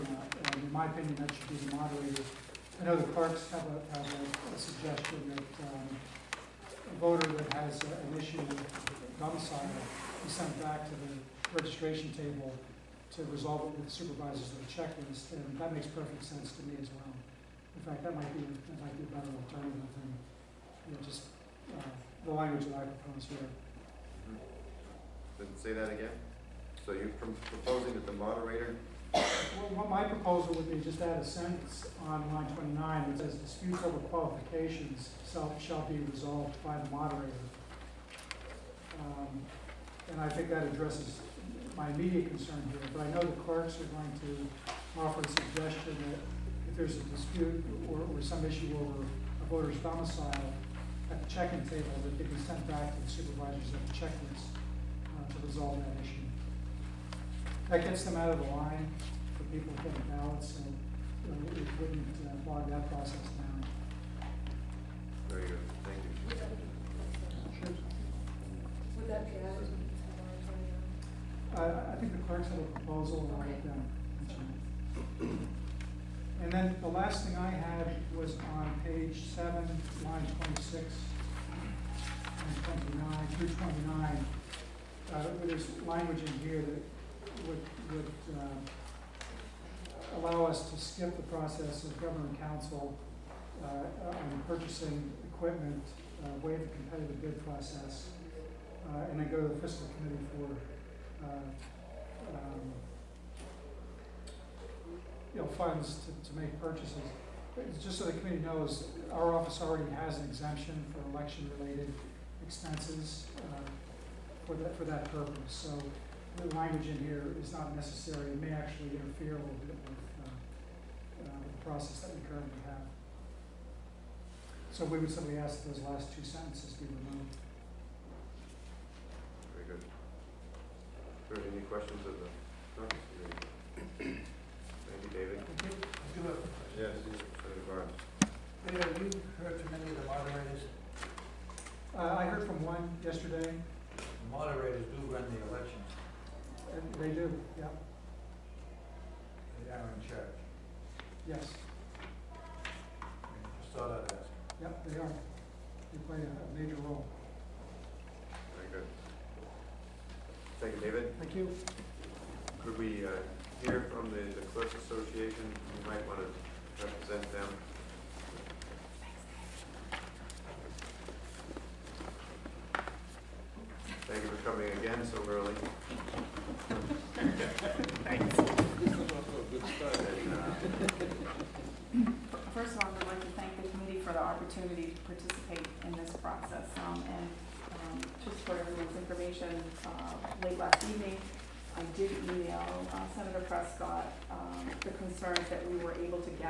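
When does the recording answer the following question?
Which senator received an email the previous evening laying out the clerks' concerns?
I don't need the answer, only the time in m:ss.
3:13.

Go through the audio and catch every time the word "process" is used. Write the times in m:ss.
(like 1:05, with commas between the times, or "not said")
1:02, 1:31, 1:37, 2:01, 3:06.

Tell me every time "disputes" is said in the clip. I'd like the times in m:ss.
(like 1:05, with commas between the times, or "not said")
0:33, 0:47.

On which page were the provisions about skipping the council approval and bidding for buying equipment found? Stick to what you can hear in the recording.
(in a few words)
Page 7.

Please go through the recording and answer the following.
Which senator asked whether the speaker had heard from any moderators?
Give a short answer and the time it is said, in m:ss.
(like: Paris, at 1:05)
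Senator Barnes, at 2:17.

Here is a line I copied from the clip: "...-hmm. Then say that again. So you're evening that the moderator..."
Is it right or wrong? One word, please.
wrong.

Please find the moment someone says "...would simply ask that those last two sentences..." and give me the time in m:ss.
2:04.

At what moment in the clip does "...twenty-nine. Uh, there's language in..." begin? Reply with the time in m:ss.
1:23.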